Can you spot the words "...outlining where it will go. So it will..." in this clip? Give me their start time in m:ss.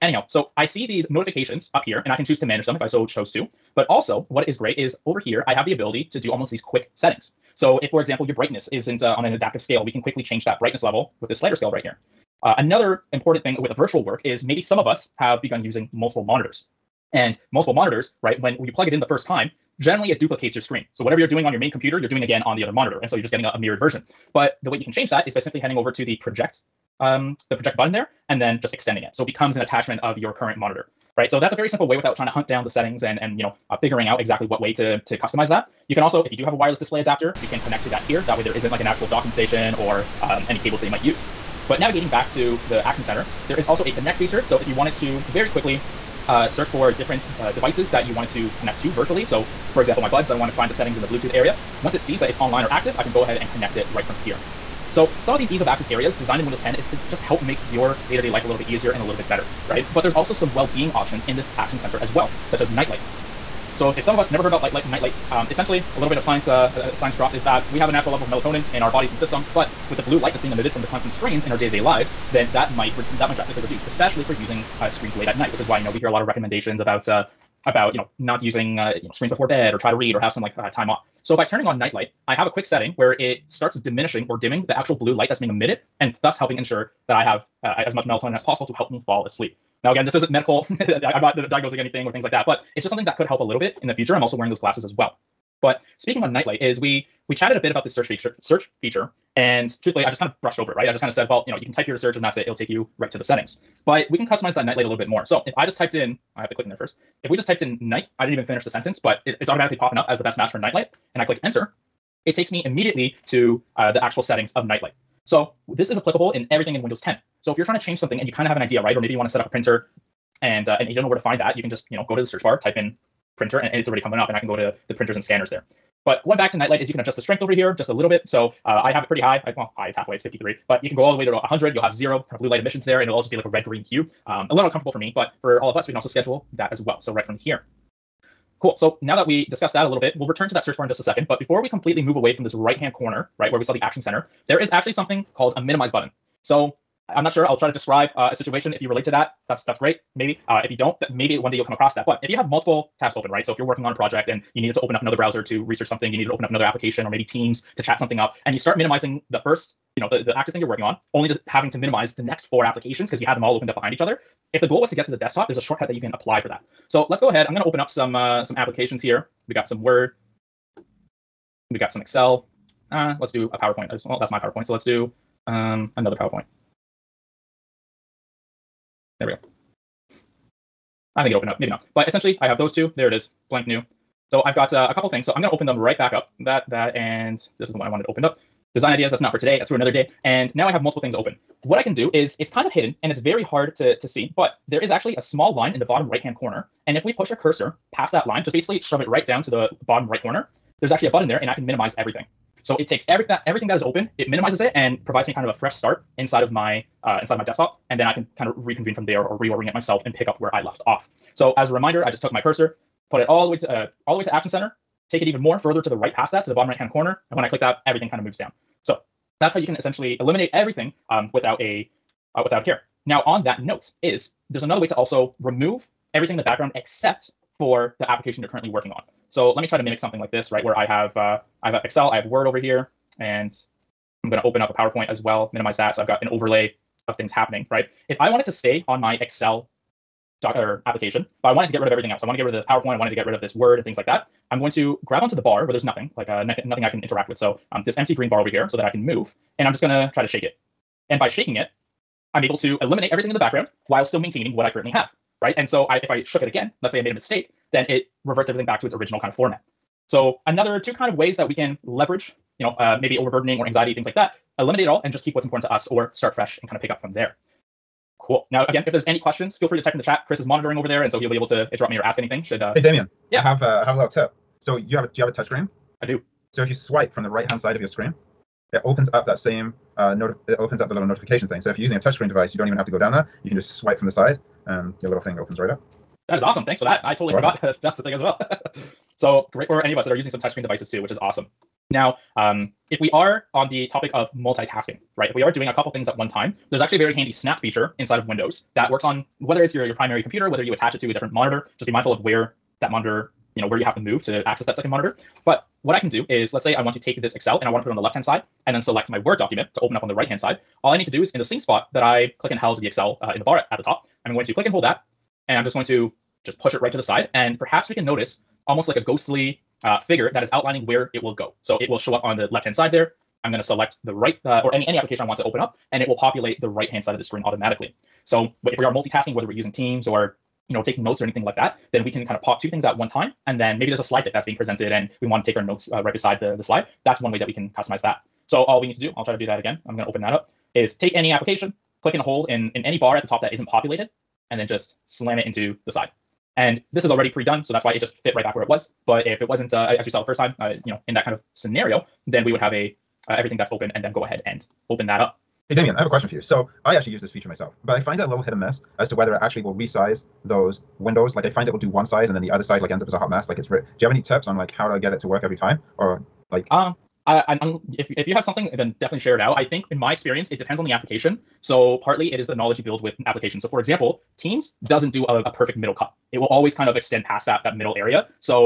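5:20.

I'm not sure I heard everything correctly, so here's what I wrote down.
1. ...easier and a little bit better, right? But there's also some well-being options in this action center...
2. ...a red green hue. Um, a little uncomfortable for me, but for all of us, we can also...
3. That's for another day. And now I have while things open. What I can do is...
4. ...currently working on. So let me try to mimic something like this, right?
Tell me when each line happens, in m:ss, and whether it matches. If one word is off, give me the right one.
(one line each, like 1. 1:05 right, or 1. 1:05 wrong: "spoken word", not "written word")
1. 0:58 right
2. 2:13 right
3. 3:09 wrong: "multiple", not "while"
4. 3:48 right.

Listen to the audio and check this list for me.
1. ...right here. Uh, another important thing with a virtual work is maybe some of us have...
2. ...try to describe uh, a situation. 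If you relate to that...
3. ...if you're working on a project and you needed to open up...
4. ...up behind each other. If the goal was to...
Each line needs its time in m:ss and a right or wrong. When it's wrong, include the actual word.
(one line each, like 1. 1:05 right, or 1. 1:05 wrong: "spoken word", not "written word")
1. 0:11 right
2. 2:27 right
3. 2:33 right
4. 2:43 right.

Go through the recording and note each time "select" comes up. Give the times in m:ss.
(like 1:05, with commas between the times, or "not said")
5:08, 5:23.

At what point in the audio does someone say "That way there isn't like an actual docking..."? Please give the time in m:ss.
0:38.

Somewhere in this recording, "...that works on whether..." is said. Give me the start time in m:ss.
4:58.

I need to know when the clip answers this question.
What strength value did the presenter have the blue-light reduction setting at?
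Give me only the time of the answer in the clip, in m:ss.
2:10.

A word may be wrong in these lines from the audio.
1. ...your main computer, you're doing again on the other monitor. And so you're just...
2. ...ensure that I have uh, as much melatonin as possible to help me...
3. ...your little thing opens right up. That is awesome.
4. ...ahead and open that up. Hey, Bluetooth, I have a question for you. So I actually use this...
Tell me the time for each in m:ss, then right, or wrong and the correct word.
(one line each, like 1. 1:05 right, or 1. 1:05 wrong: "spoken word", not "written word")
1. 0:21 right
2. 1:26 right
3. 4:45 right
4. 5:54 wrong: "Damien", not "Bluetooth".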